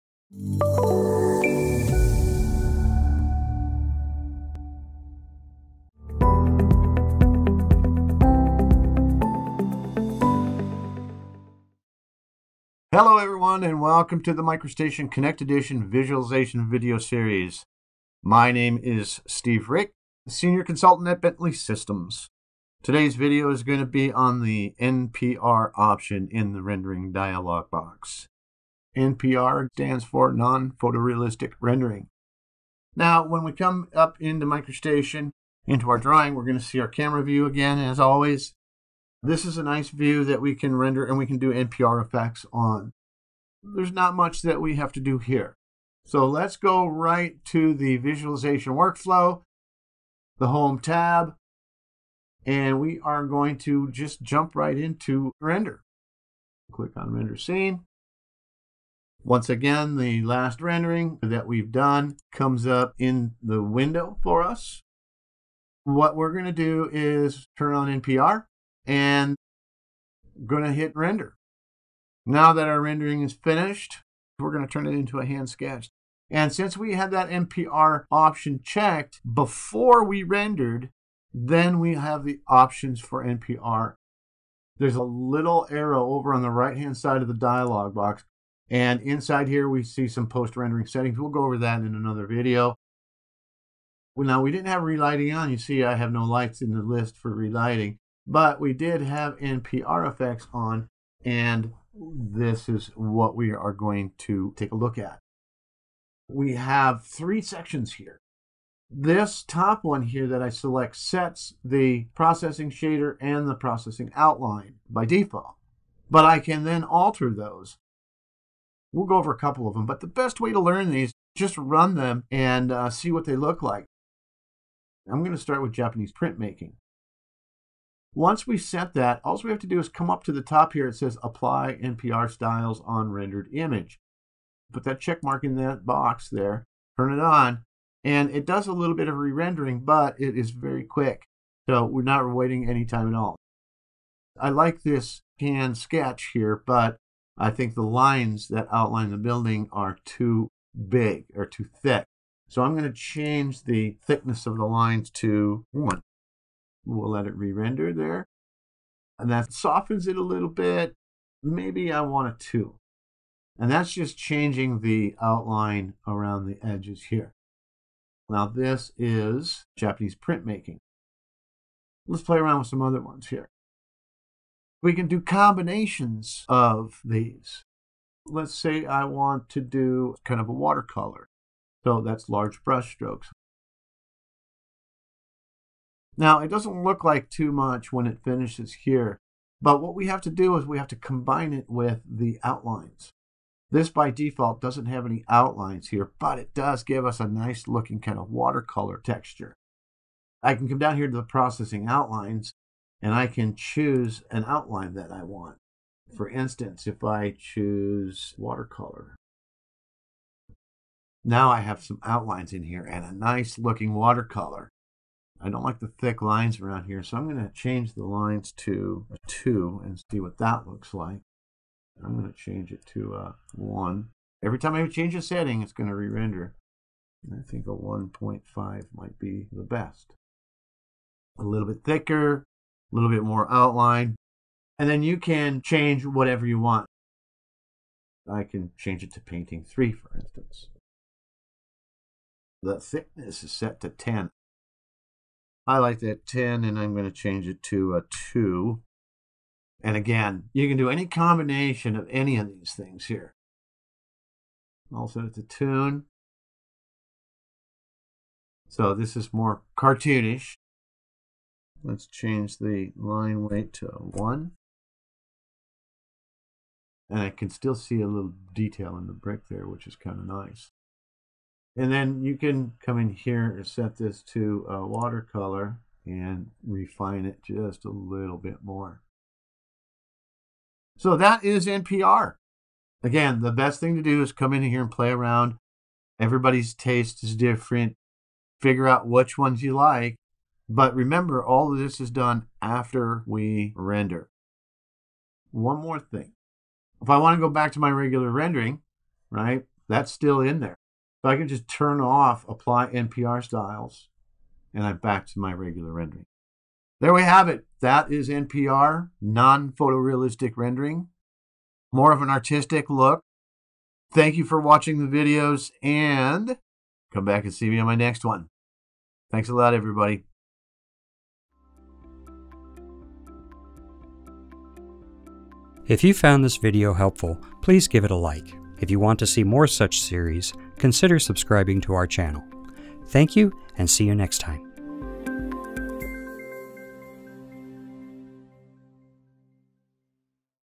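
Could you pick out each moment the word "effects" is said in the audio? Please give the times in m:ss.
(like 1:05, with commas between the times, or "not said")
0:42, 1:40.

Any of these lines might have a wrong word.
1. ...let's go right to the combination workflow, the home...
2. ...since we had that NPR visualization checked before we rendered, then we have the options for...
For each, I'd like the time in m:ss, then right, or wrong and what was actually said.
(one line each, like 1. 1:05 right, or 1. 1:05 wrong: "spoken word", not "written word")
1. 0:46 wrong: "visualization", not "combination"
2. 1:16 wrong: "option", not "visualization".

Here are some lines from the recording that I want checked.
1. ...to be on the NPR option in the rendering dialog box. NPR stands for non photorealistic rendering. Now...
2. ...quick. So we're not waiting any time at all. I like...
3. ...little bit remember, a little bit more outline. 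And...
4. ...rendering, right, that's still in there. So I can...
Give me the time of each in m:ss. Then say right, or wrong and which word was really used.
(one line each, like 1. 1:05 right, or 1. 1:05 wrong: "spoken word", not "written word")
1. 0:23 right
2. 2:20 right
3. 3:51 wrong: "thicker", not "remember"
4. 4:58 right.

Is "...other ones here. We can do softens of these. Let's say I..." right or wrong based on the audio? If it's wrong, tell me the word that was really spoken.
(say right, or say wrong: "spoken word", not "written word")
wrong: "combinations", not "softens".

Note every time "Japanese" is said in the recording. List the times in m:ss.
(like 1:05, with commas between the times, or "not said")
2:05, 2:49.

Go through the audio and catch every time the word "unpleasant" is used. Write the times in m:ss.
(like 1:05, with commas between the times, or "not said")
not said.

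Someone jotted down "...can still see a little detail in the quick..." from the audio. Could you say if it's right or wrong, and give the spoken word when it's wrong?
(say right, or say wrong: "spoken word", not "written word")
wrong: "brick", not "quick".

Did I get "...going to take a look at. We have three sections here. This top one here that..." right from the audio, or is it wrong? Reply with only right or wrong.
right.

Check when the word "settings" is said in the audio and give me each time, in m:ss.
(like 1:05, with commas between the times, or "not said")
1:30, 3:45.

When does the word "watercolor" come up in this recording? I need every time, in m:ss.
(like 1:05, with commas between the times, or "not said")
3:00, 3:18, 3:28, 3:33, 4:34.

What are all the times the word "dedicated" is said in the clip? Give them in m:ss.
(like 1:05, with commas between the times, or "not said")
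not said.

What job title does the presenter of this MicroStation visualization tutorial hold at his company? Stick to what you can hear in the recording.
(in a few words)
Senior Consultant.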